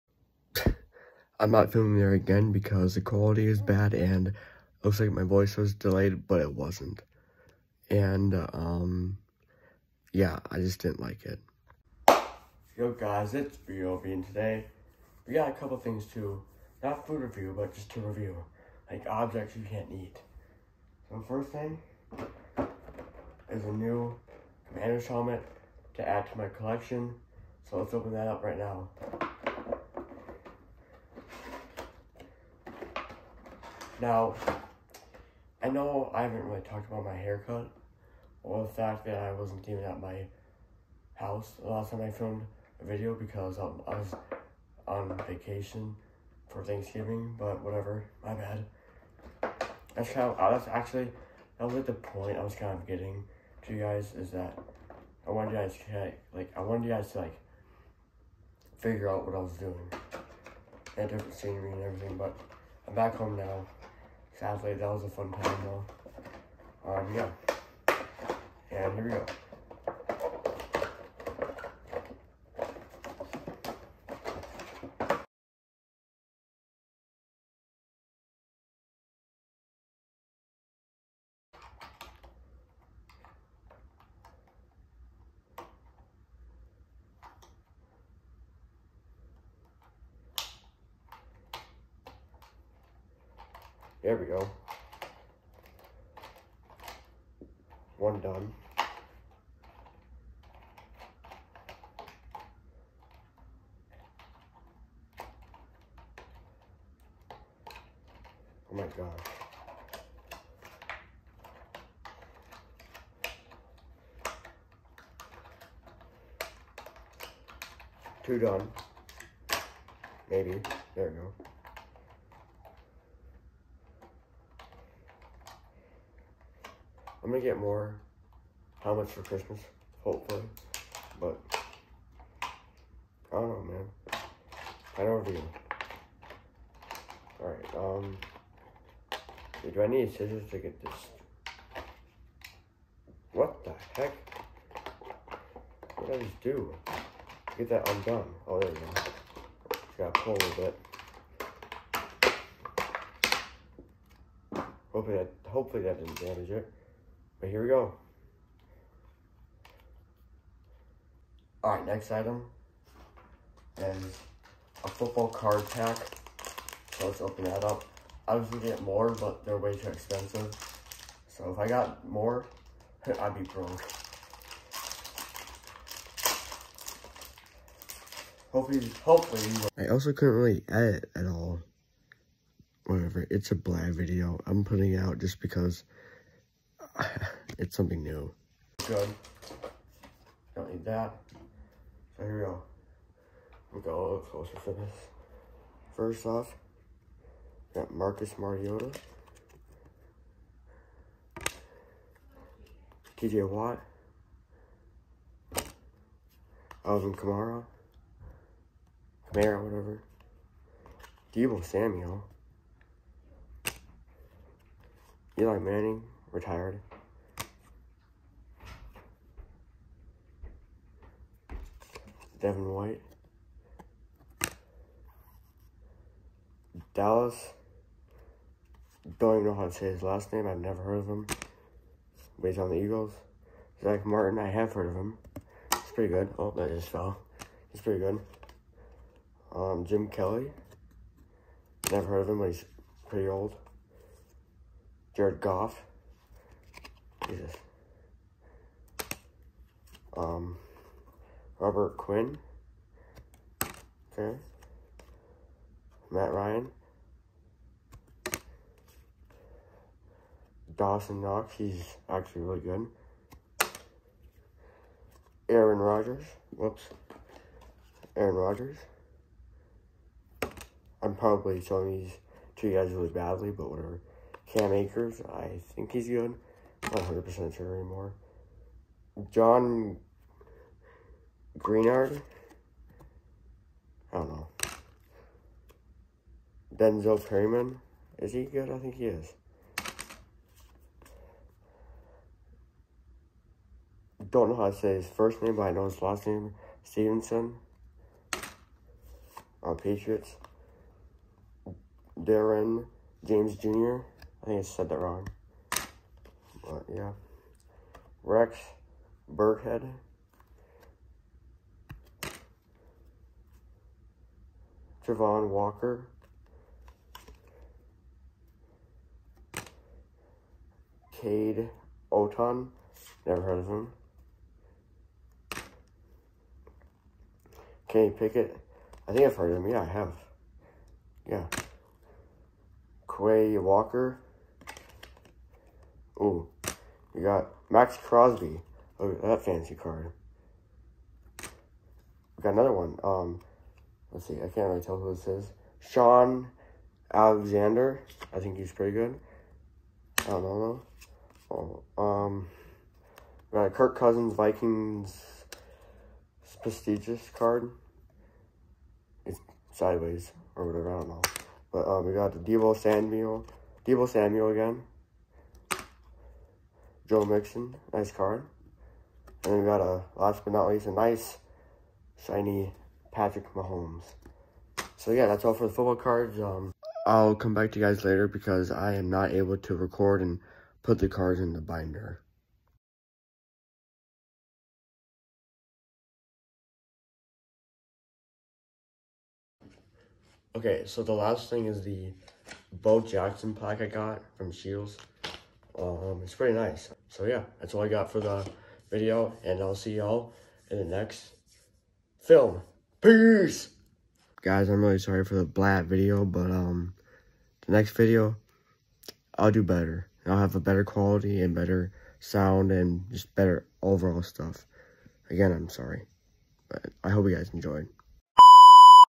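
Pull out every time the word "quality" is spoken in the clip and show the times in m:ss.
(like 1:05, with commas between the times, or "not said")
0:03, 6:50.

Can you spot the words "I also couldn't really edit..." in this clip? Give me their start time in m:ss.
2:59.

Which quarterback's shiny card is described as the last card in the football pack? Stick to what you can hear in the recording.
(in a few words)
Patrick Mahomes.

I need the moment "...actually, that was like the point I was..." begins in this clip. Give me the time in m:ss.
0:50.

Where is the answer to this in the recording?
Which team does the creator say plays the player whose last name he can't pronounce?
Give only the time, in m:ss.
3:52.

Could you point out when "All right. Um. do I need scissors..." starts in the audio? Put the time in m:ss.
2:17.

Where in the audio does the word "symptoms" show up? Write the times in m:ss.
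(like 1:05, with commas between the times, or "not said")
not said.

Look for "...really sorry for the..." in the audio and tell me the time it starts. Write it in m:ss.
6:44.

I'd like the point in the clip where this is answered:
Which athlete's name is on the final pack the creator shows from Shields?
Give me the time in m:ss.
6:32.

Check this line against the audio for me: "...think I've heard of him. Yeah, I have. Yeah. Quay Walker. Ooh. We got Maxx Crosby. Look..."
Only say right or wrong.
right.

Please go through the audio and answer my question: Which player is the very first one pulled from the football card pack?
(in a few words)
Marcus Mariota.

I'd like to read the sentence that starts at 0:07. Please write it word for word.
And, um, yeah, I just didn't like it.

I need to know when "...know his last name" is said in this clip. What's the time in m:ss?
4:55.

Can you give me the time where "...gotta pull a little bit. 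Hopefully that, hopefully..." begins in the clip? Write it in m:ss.
2:29.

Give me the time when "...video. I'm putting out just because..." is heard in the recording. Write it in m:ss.
3:03.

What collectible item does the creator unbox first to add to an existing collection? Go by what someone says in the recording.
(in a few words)
Commander's helmet.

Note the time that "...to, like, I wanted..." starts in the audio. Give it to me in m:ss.
0:55.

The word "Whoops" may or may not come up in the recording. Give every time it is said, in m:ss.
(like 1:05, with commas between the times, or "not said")
4:26.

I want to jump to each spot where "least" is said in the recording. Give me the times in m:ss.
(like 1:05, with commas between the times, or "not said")
6:10.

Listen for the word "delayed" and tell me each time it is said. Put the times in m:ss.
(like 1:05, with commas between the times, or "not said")
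0:05.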